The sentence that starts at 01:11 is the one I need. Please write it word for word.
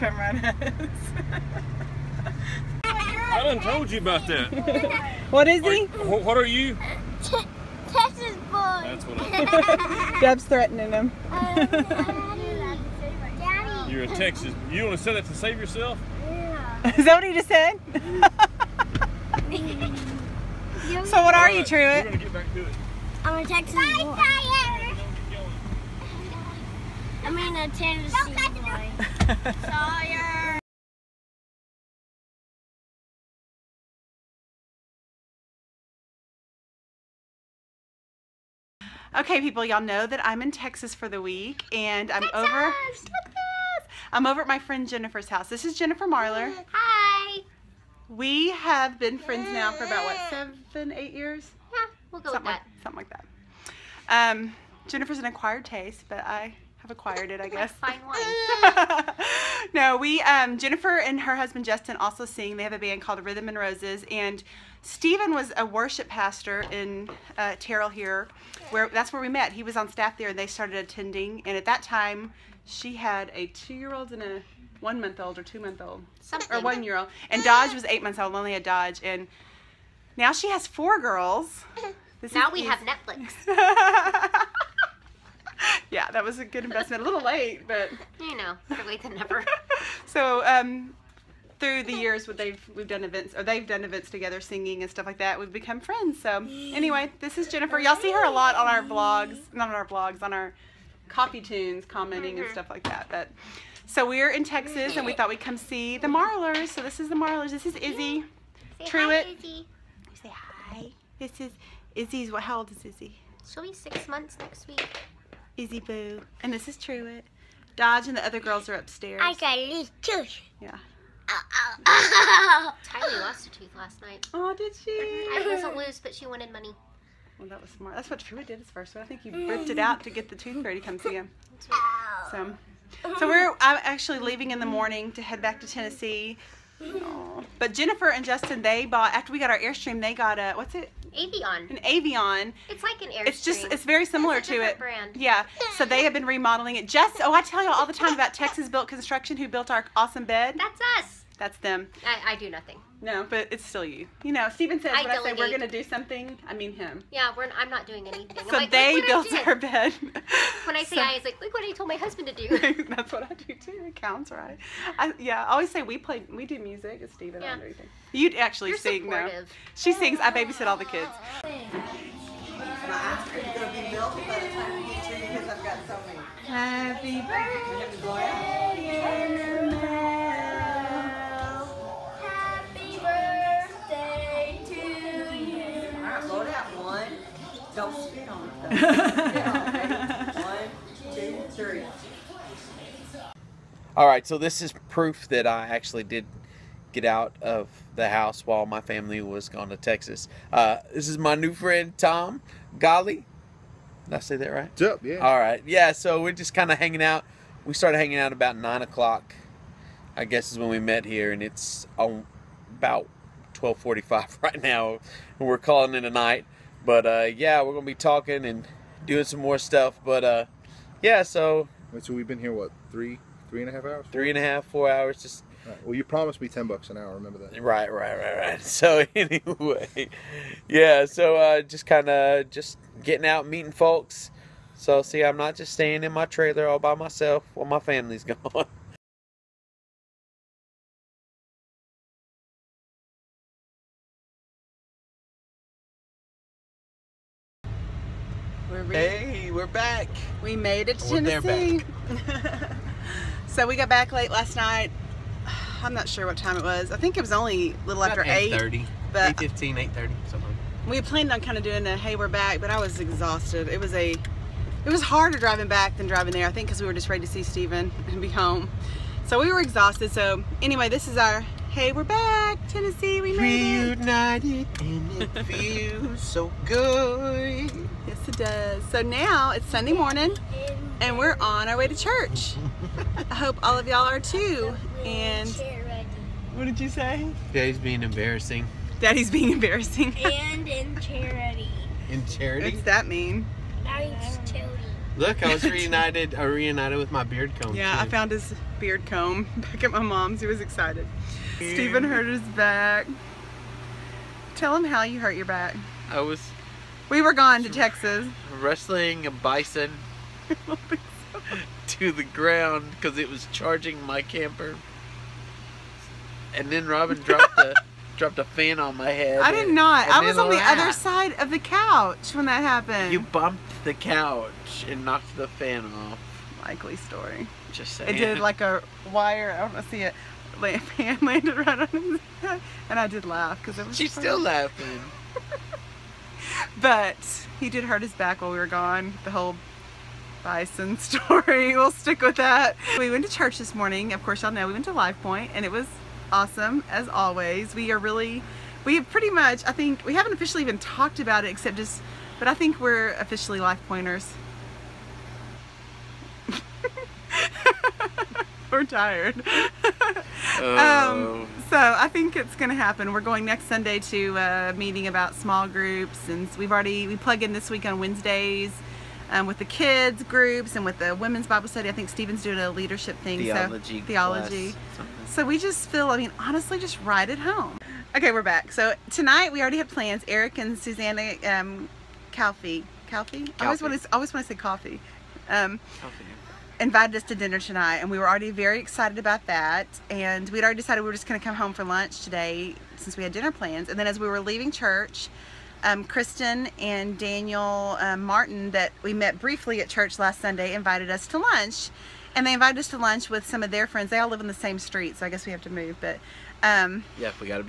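And at that time, she had a two-year-old and a one-month-old or two-month-old, or one-year-old.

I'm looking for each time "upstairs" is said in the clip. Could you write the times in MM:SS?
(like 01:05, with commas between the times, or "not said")
01:58.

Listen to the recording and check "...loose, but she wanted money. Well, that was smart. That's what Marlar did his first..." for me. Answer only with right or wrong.
wrong.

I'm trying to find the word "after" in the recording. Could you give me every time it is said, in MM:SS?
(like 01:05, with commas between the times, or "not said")
02:19, 04:18.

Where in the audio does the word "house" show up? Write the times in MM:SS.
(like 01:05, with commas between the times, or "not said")
00:45, 03:18.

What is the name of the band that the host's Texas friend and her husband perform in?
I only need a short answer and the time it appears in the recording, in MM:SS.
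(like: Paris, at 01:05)
Rhythm and Roses, at 01:03.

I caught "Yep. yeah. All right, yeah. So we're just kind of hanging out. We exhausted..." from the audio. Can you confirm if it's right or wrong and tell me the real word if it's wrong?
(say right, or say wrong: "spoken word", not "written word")
wrong: "started", not "exhausted".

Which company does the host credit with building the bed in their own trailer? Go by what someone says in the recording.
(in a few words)
Texas Built Construction.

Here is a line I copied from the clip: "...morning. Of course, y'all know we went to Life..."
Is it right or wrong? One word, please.
right.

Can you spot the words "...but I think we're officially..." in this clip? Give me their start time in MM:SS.
05:52.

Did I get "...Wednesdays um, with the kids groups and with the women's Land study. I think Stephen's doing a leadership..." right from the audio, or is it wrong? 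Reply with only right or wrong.
wrong.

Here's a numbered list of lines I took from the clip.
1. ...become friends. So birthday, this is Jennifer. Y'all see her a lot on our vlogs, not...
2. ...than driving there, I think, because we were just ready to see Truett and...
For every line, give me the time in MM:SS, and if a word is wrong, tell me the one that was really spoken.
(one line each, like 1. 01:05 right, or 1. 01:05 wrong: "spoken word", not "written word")
1. 01:35 wrong: "anyway", not "birthday"
2. 04:25 wrong: "Steven", not "Truett".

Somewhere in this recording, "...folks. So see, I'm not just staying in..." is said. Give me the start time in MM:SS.
03:53.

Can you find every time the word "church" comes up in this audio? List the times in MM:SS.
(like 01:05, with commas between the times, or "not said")
04:41, 05:43, 06:34, 06:39.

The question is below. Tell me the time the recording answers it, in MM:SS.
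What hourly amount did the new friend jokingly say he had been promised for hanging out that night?
03:46.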